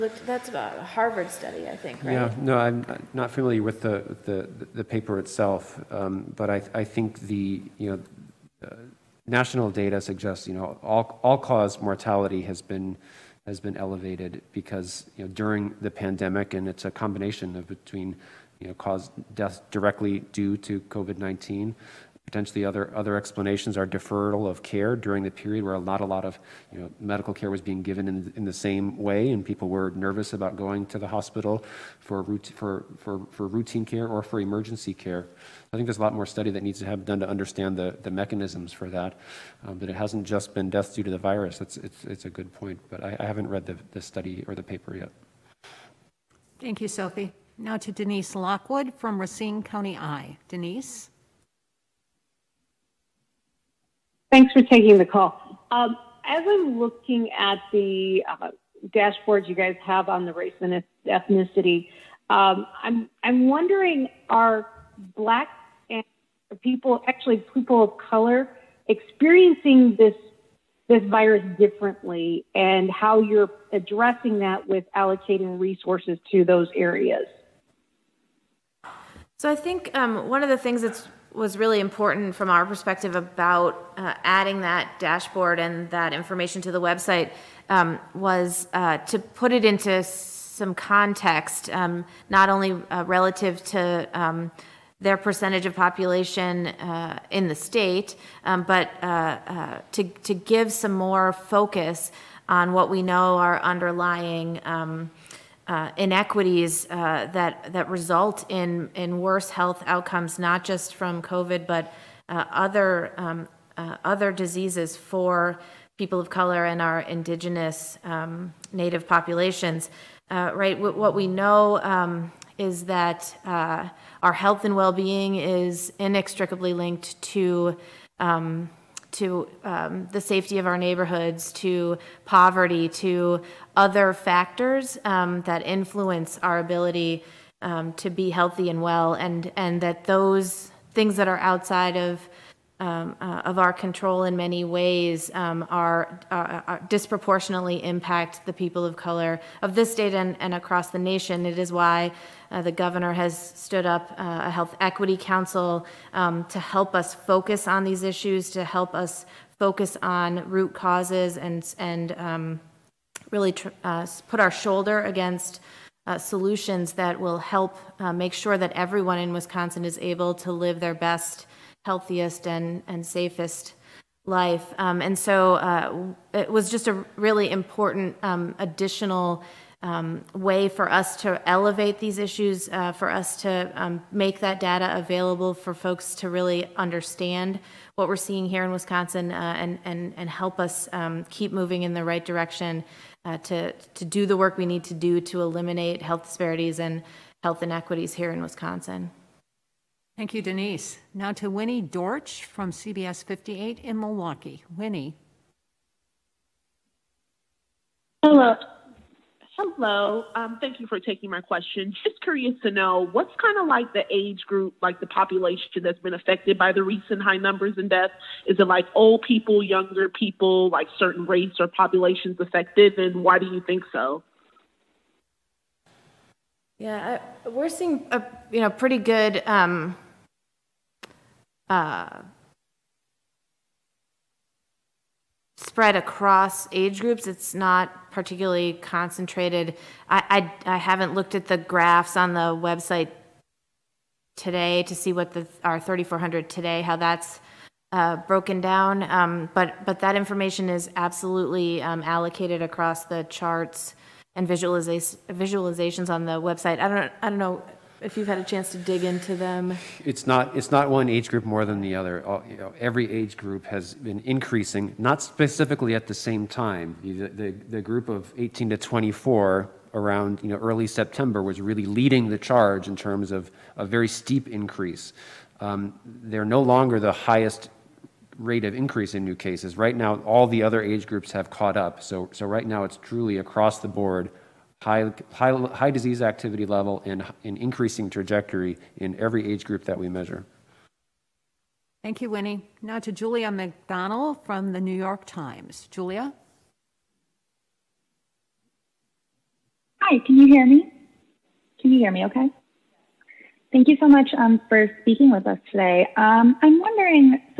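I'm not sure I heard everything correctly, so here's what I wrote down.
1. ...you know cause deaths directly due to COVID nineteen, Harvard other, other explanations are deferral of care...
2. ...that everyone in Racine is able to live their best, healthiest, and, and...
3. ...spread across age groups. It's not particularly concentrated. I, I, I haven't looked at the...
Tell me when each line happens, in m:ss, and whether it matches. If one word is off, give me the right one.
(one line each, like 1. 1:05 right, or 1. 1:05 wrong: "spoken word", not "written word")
1. 0:18 wrong: "Potentially", not "Harvard"
2. 2:48 wrong: "Wisconsin", not "Racine"
3. 3:55 right.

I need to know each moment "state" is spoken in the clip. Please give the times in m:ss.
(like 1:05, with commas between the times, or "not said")
1:37, 2:29.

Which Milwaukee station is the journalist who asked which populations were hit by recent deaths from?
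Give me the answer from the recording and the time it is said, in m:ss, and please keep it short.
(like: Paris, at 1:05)
CBS 58, at 3:22.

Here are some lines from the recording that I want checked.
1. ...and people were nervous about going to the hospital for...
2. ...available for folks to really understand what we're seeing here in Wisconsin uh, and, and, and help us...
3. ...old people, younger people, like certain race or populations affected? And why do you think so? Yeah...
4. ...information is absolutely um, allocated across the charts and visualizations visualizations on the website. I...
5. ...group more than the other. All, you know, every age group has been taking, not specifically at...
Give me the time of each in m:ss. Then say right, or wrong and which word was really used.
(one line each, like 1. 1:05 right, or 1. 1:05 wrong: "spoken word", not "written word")
1. 0:29 right
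2. 3:04 right
3. 3:38 right
4. 4:10 right
5. 4:21 wrong: "increasing", not "taking".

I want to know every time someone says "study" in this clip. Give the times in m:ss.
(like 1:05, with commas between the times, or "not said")
0:01, 0:36, 0:44.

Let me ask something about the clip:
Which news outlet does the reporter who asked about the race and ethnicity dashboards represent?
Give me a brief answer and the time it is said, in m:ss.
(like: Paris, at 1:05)
Racine County Eye, at 0:49.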